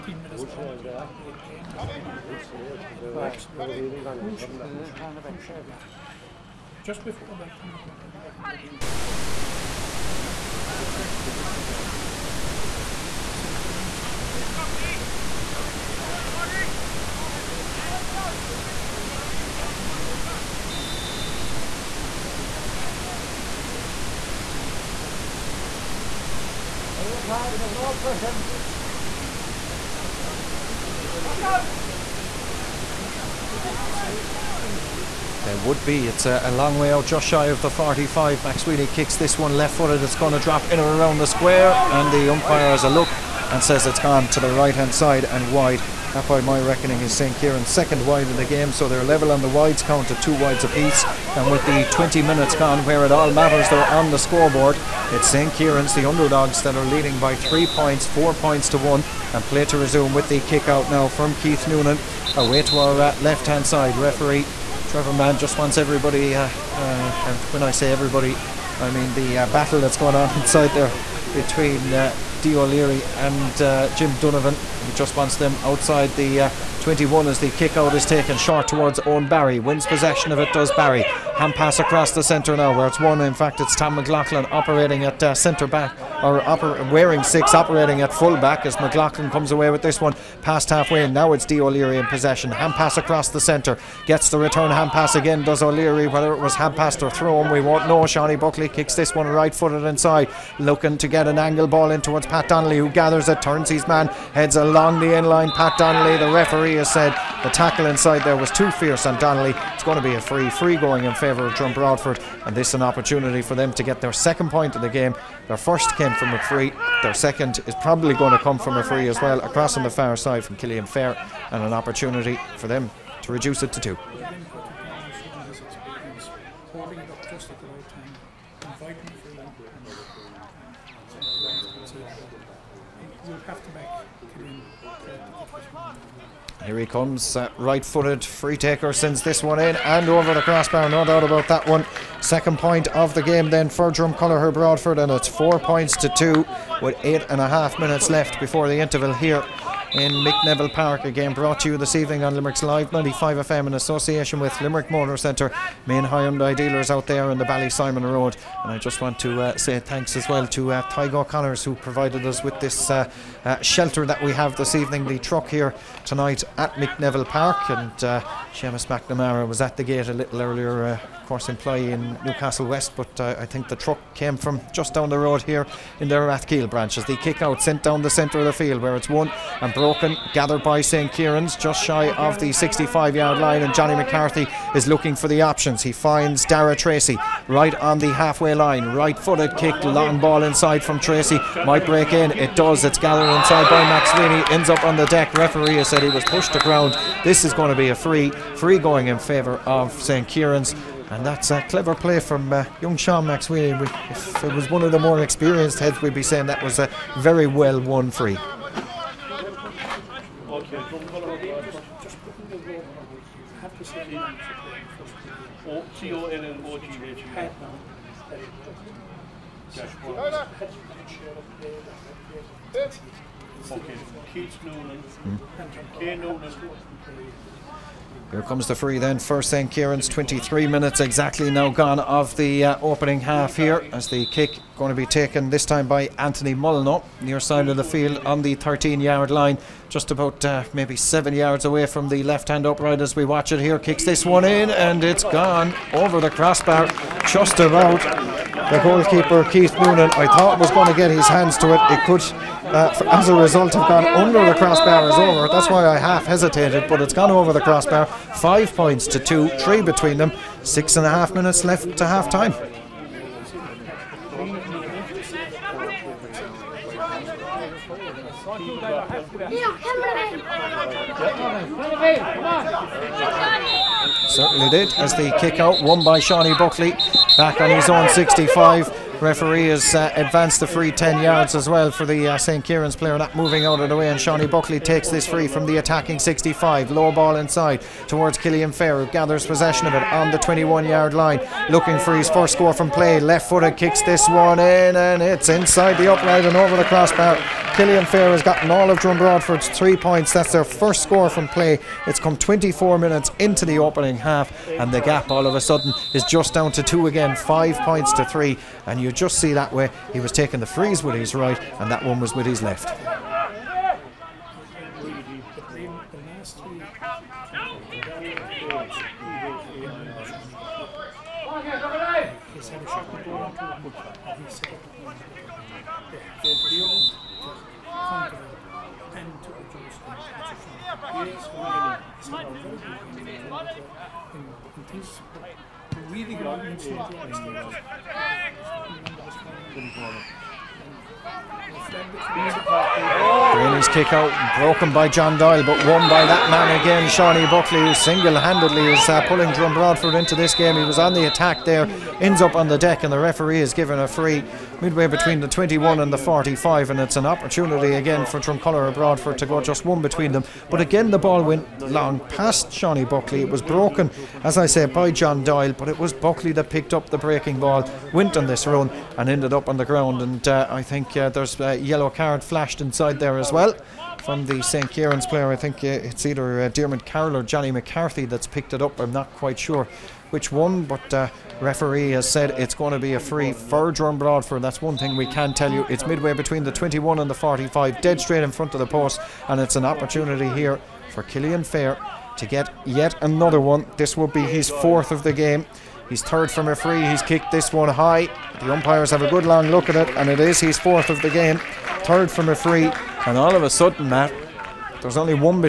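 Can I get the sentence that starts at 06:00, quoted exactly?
But again, the ball went long past Shawnee Buckley.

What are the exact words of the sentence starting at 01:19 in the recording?
Wins possession of it, does Barry.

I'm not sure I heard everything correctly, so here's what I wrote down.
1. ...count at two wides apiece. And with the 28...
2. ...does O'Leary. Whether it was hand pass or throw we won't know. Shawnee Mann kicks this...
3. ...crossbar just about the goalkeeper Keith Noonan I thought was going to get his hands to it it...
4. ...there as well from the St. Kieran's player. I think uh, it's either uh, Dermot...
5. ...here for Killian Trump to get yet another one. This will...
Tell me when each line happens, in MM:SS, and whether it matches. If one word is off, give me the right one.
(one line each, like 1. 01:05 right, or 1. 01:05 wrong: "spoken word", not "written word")
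1. 00:49 wrong: "20", not "28"
2. 01:35 wrong: "Buckley", not "Mann"
3. 04:06 right
4. 06:13 right
5. 06:30 wrong: "Fair", not "Trump".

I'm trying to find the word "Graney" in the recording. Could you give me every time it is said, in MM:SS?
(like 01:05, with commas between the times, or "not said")
05:43.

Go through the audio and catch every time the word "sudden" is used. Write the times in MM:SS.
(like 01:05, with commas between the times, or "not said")
05:05, 06:43.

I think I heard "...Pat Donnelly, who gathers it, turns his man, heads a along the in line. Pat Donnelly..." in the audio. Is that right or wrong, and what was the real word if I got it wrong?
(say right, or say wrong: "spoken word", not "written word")
right.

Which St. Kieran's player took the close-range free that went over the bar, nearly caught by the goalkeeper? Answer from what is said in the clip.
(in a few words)
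Anthony Molyneux.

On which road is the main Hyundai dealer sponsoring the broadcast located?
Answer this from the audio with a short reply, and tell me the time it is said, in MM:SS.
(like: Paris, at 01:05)
Ballysimon Road, at 02:37.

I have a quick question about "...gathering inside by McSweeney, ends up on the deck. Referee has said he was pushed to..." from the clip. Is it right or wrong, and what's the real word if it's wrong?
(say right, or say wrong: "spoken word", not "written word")
right.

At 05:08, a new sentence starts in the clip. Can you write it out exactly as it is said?
And you could just see that way he was taking the freeze with his right and that one was with his left.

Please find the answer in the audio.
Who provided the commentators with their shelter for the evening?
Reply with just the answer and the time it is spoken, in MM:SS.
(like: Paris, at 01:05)
Tygo Connors, at 02:40.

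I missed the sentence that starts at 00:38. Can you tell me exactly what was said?
McSweeney kicks this one left footed.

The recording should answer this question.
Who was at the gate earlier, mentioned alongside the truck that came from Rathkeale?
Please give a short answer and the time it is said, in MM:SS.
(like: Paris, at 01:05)
Seamus McNamara, at 02:48.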